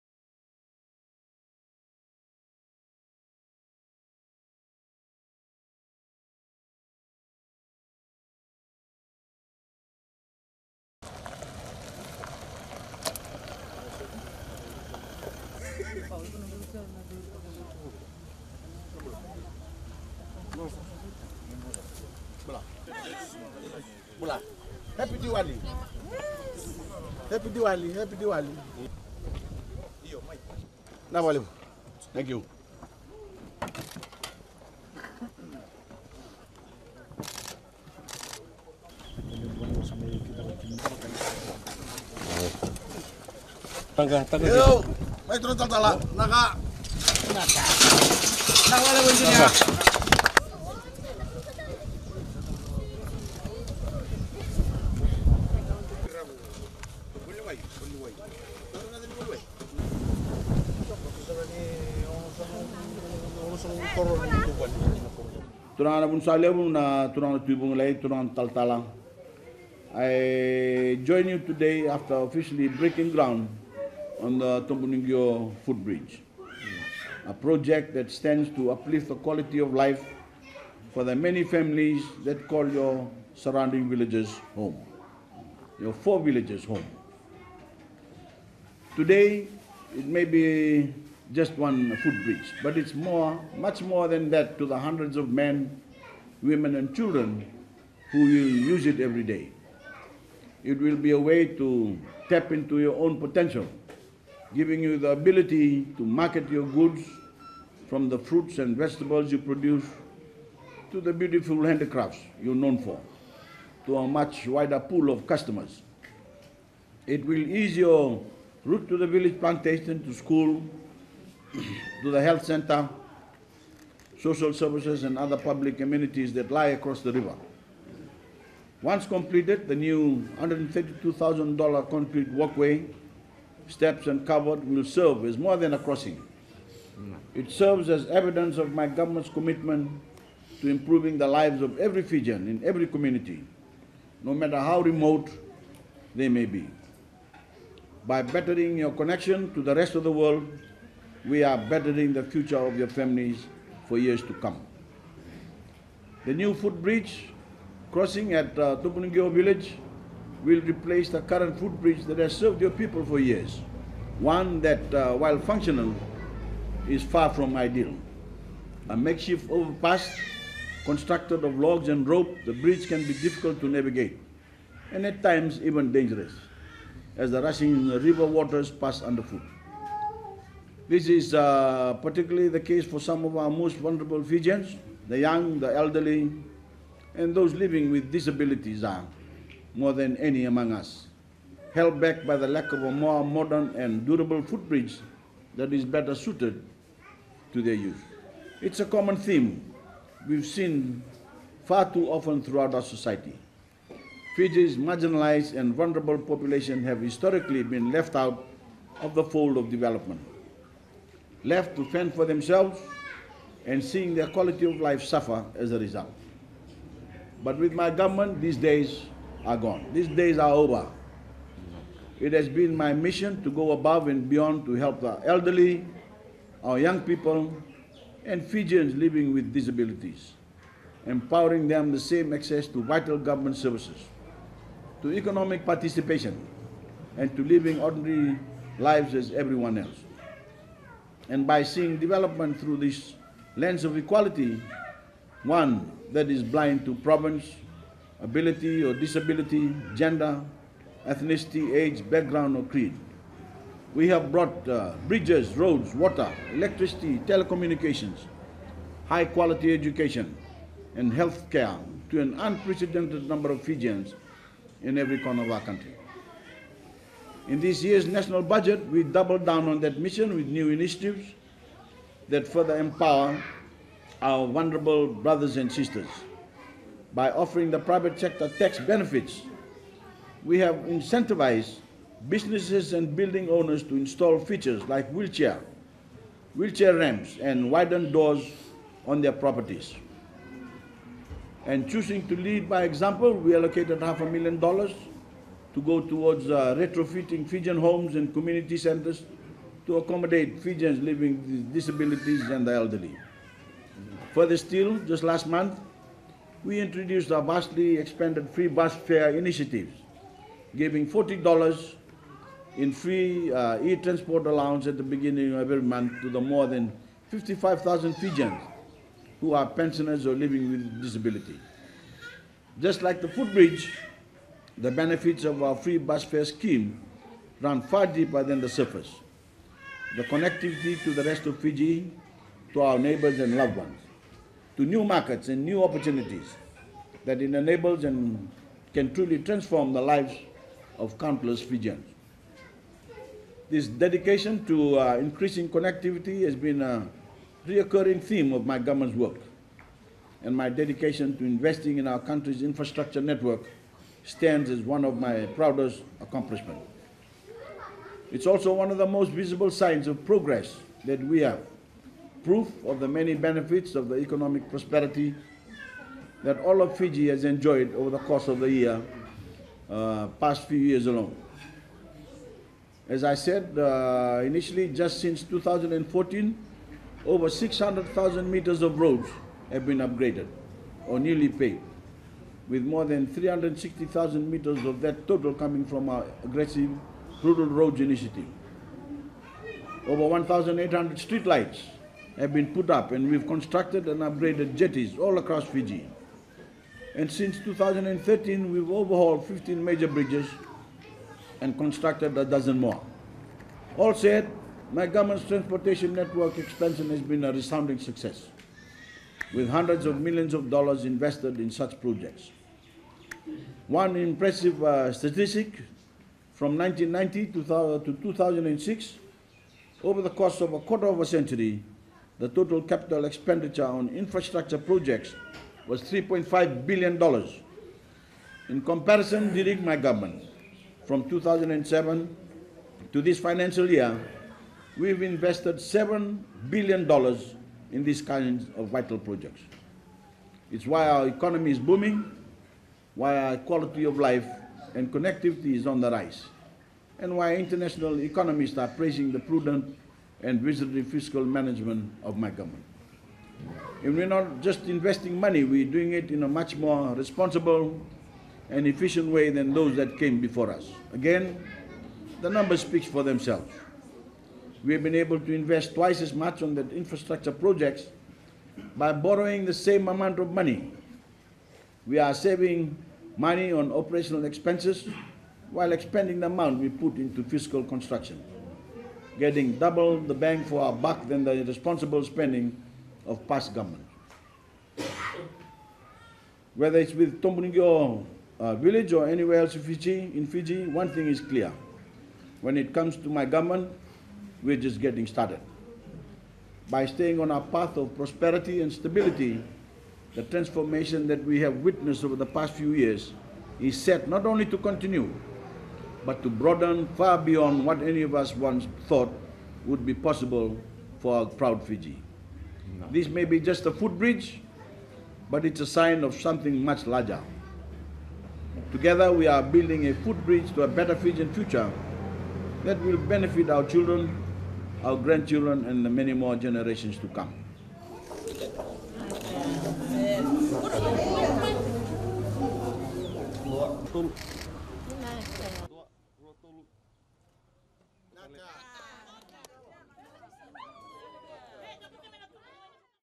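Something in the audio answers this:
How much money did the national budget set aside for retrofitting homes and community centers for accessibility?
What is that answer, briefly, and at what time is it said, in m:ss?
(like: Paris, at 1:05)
half a million dollars, at 4:54.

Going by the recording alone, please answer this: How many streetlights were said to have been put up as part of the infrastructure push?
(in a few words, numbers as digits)
1,800.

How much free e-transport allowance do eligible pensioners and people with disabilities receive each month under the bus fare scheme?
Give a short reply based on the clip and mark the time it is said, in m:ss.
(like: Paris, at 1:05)
$40, at 5:11.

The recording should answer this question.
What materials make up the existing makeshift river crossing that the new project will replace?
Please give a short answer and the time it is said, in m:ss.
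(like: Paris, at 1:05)
logs and rope, at 2:51.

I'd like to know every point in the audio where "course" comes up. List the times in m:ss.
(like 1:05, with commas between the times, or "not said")
6:08, 7:00.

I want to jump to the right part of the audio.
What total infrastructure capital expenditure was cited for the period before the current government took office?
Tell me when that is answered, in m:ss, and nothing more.
7:06.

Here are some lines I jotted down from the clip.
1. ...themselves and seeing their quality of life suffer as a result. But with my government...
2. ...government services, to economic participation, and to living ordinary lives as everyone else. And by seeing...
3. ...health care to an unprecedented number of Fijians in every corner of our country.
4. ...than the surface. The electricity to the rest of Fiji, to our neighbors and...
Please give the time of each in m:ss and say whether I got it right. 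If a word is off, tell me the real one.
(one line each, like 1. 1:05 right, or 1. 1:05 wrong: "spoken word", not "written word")
1. 3:32 right
2. 3:53 right
3. 4:21 right
4. 5:28 wrong: "connectivity", not "electricity".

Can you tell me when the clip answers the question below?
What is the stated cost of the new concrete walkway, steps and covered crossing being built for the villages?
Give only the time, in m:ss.
2:10.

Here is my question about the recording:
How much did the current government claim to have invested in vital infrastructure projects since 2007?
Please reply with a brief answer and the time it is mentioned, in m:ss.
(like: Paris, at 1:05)
$7 billion, at 7:15.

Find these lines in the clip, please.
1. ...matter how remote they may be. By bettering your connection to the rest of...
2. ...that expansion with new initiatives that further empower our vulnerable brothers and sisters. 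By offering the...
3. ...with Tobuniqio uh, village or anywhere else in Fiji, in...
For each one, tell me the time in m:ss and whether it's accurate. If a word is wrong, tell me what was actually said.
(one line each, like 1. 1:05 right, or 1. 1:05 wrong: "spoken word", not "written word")
1. 2:24 right
2. 4:29 wrong: "mission", not "expansion"
3. 8:07 right.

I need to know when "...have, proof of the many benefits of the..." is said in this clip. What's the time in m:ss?
6:01.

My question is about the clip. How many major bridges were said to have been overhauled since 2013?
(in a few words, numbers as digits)
15.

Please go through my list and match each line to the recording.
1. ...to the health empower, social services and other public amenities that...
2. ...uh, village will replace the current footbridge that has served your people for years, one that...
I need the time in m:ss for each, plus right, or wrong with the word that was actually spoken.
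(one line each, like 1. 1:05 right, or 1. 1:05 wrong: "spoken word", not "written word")
1. 2:02 wrong: "center", not "empower"
2. 2:38 right.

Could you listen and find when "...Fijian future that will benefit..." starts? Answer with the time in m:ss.
8:41.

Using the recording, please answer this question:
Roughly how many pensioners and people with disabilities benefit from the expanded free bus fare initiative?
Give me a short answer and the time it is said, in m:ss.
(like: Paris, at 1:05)
55,000, at 5:17.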